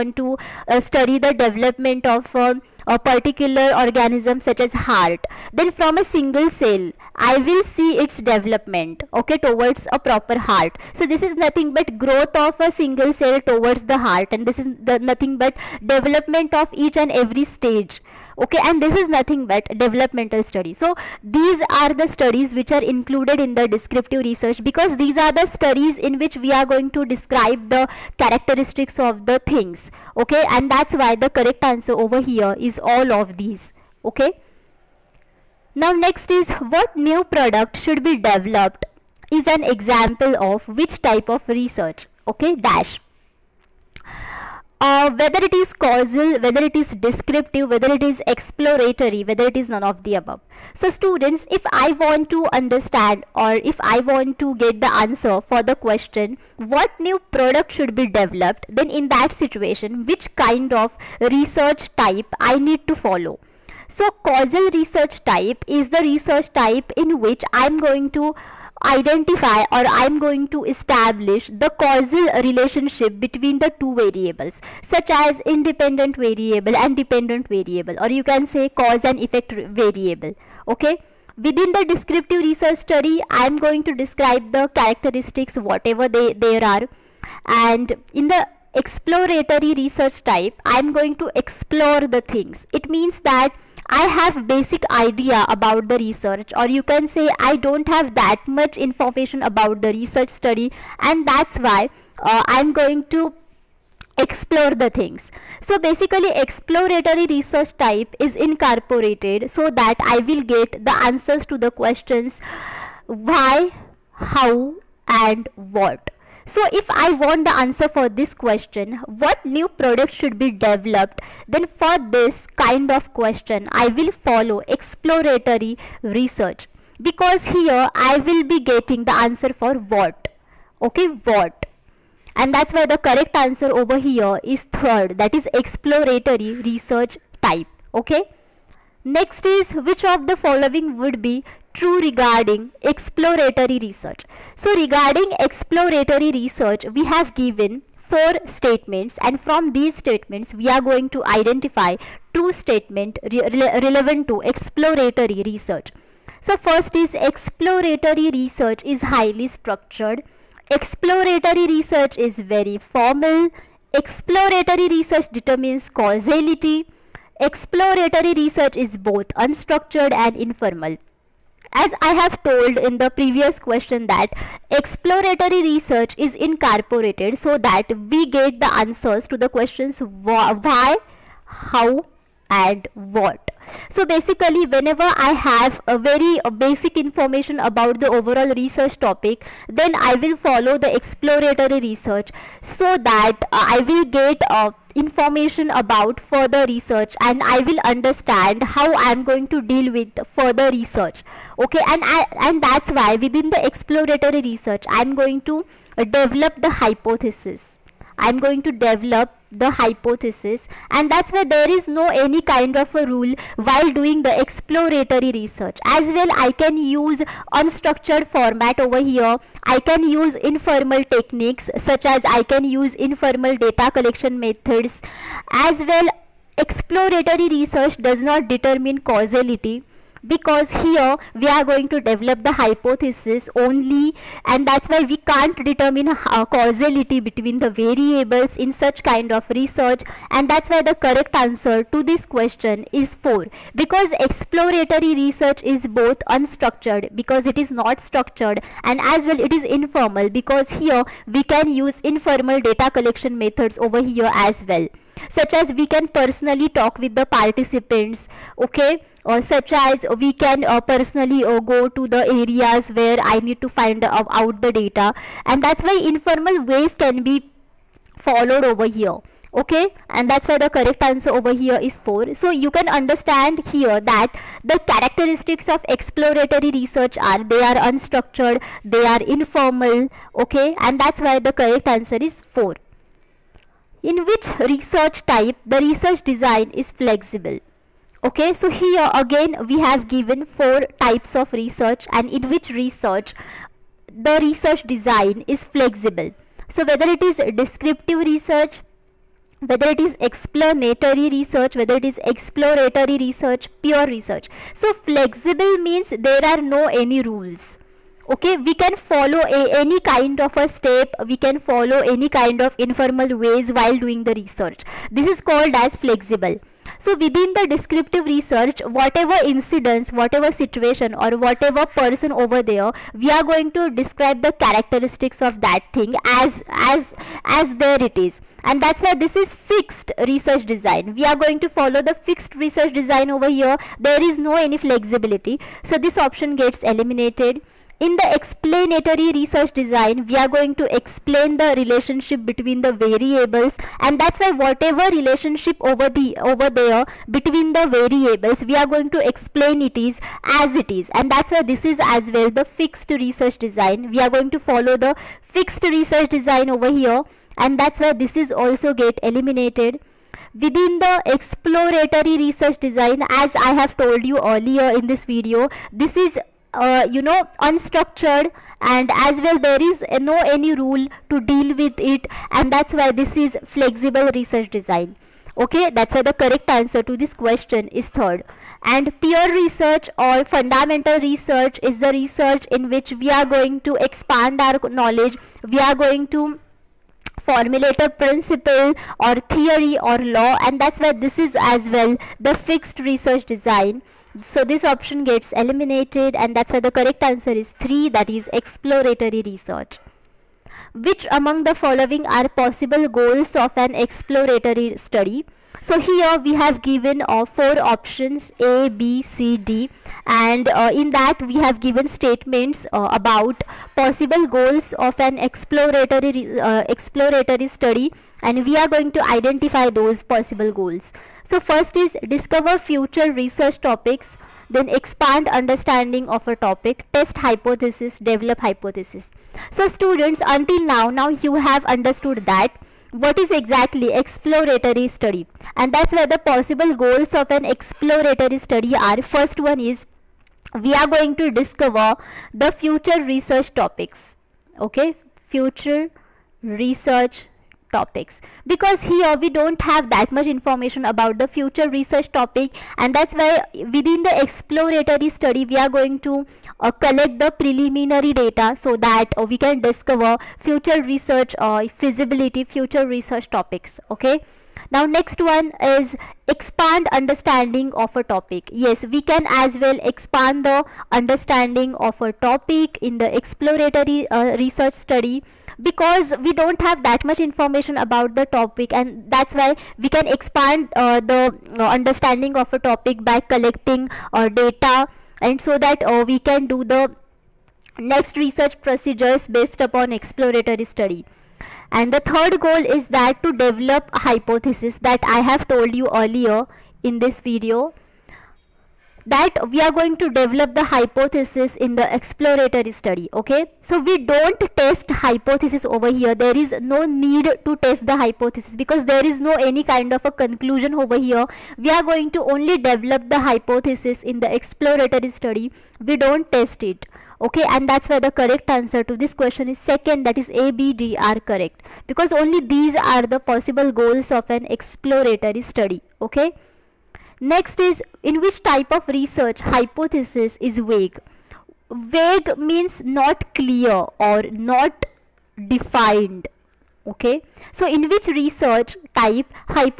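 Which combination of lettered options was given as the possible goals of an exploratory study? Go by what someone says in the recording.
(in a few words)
A, B, D.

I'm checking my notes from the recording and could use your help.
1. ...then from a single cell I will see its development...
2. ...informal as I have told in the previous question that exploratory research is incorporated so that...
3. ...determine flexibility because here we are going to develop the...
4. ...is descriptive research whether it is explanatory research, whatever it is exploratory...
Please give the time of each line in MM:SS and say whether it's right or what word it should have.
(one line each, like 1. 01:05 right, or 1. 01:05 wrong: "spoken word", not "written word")
1. 00:05 right
2. 02:50 right
3. 03:48 wrong: "causality", not "flexibility"
4. 04:57 wrong: "whether", not "whatever".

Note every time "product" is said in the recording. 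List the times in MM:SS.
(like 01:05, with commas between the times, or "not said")
00:37, 00:57, 01:59.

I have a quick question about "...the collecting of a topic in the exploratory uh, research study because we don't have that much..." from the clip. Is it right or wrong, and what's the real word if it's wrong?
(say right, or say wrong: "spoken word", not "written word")
wrong: "understanding", not "collecting".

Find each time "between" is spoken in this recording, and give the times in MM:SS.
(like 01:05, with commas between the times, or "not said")
01:13, 03:57, 05:42, 05:47.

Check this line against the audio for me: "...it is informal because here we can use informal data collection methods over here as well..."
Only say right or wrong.
right.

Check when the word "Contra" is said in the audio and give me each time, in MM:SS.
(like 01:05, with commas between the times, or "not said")
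not said.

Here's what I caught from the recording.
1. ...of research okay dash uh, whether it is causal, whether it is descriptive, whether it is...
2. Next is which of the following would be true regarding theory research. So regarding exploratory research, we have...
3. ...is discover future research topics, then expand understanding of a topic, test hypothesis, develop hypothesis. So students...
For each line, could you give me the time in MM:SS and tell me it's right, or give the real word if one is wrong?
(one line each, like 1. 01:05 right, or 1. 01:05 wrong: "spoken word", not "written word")
1. 00:41 right
2. 02:19 wrong: "exploratory", not "theory"
3. 07:01 right.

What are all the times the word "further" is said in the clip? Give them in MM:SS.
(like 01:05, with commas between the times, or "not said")
03:16, 03:20.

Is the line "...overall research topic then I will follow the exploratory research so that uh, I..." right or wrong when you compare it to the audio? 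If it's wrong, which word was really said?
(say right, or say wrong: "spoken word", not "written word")
right.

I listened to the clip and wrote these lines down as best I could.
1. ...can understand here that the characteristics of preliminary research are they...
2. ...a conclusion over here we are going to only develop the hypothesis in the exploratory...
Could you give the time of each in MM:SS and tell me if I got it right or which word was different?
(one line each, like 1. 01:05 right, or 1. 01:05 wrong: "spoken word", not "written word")
1. 04:32 wrong: "exploratory", not "preliminary"
2. 08:30 right.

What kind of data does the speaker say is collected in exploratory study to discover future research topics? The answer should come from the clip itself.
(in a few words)
Preliminary data.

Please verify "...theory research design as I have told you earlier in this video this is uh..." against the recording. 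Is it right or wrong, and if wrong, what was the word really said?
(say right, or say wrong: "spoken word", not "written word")
wrong: "exploratory", not "theory".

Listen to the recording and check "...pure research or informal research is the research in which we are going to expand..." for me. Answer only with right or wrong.
wrong.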